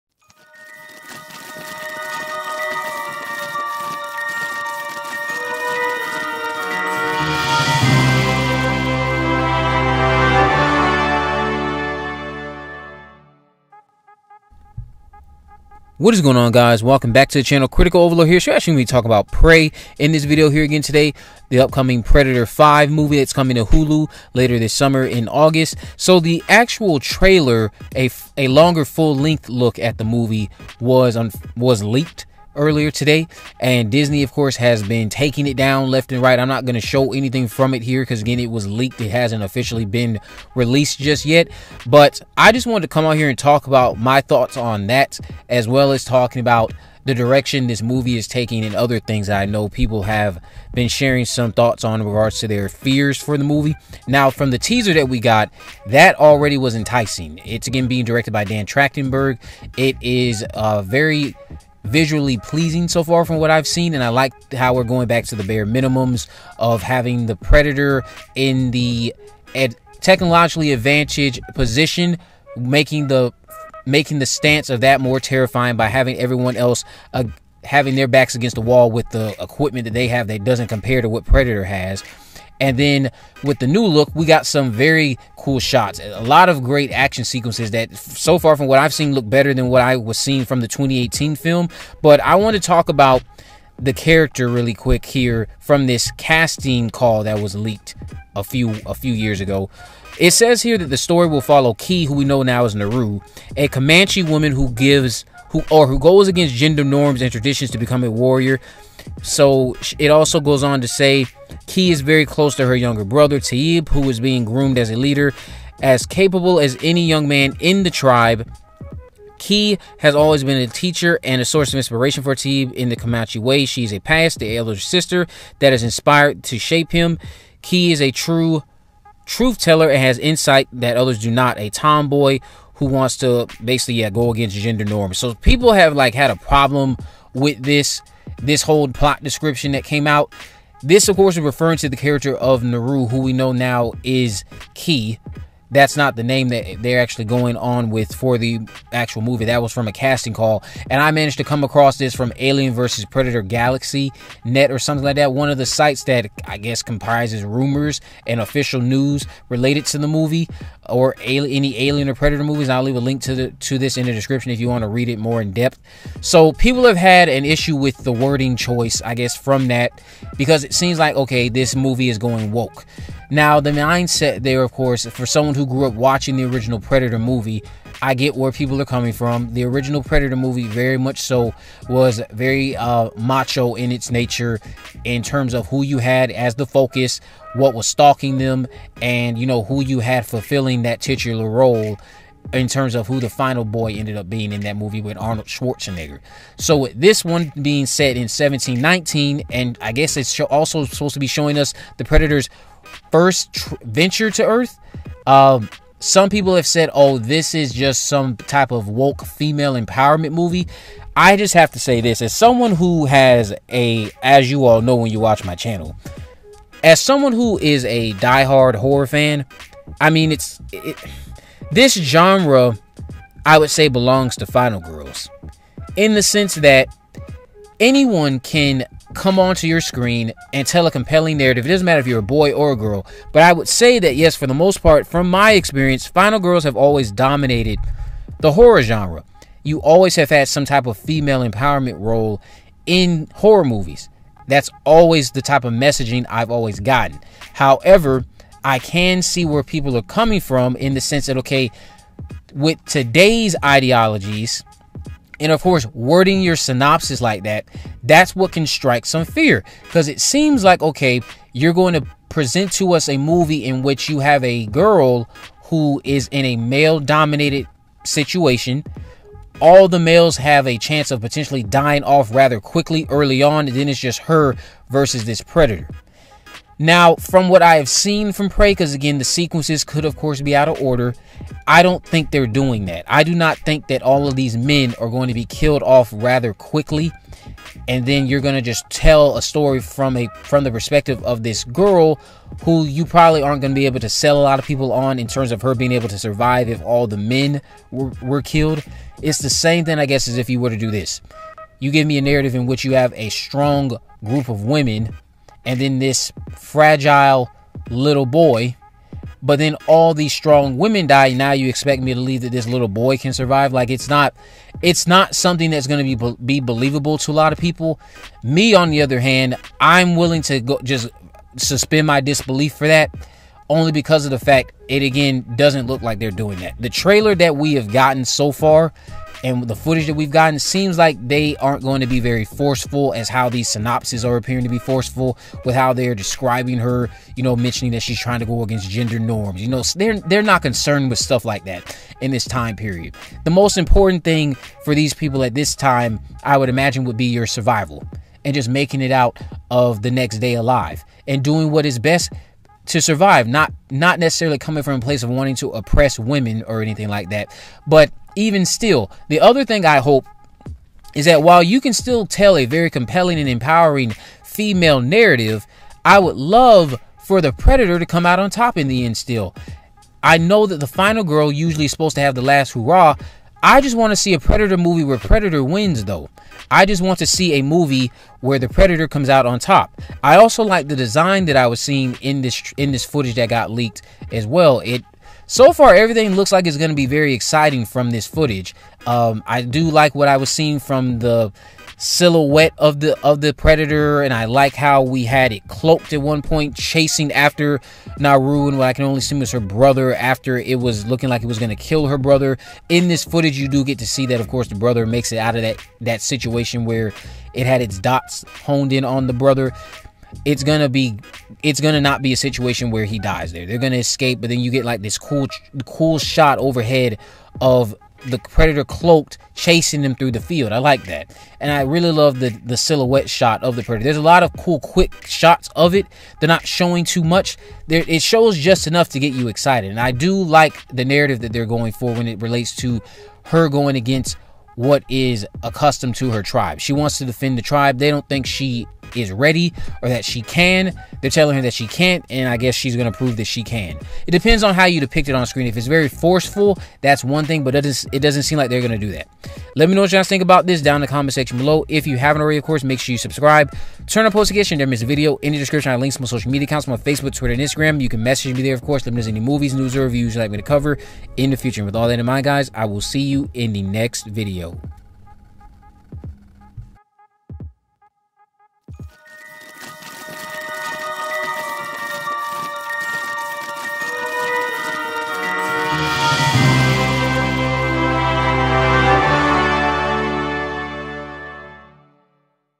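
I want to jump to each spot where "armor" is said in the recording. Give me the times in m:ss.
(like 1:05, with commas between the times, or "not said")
not said.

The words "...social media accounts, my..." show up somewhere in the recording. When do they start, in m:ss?
7:36.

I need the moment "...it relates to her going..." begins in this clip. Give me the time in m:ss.
7:12.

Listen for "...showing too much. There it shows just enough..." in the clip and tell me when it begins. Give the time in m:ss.
7:06.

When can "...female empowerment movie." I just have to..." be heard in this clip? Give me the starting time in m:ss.
3:29.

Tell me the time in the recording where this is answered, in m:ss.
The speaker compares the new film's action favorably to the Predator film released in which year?
1:30.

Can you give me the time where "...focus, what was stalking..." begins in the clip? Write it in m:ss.
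3:06.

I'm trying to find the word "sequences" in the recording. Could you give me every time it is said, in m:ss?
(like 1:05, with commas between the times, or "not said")
1:27, 4:39.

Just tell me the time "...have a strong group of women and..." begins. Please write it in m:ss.
5:02.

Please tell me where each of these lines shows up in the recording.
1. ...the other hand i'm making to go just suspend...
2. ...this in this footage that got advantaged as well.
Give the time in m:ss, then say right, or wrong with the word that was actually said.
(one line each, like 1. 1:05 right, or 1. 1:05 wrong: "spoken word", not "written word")
1. 5:18 wrong: "willing", not "making"
2. 6:22 wrong: "leaked", not "advantaged".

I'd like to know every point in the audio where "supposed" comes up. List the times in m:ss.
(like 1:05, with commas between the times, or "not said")
3:20, 6:11.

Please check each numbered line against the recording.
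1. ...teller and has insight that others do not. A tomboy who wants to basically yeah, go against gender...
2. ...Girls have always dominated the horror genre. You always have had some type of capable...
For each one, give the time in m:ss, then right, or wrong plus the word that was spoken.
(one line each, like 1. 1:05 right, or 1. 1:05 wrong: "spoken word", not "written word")
1. 2:09 right
2. 3:56 wrong: "female", not "capable".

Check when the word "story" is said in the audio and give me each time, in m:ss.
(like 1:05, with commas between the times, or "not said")
1:40, 4:49.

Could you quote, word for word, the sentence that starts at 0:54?
Now, from the teaser that we got, that already was enticing.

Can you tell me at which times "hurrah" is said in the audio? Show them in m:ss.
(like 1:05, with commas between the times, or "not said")
6:12.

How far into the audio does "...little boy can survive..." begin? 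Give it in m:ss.
5:12.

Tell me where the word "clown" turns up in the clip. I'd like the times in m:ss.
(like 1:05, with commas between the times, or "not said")
not said.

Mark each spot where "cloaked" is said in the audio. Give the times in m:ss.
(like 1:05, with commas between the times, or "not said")
6:35, 6:58.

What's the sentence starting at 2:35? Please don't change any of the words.
One of the sites that I guess comprises rumors and official news related to the movie or any Alien or Predator movies.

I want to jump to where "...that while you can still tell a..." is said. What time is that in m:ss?
6:01.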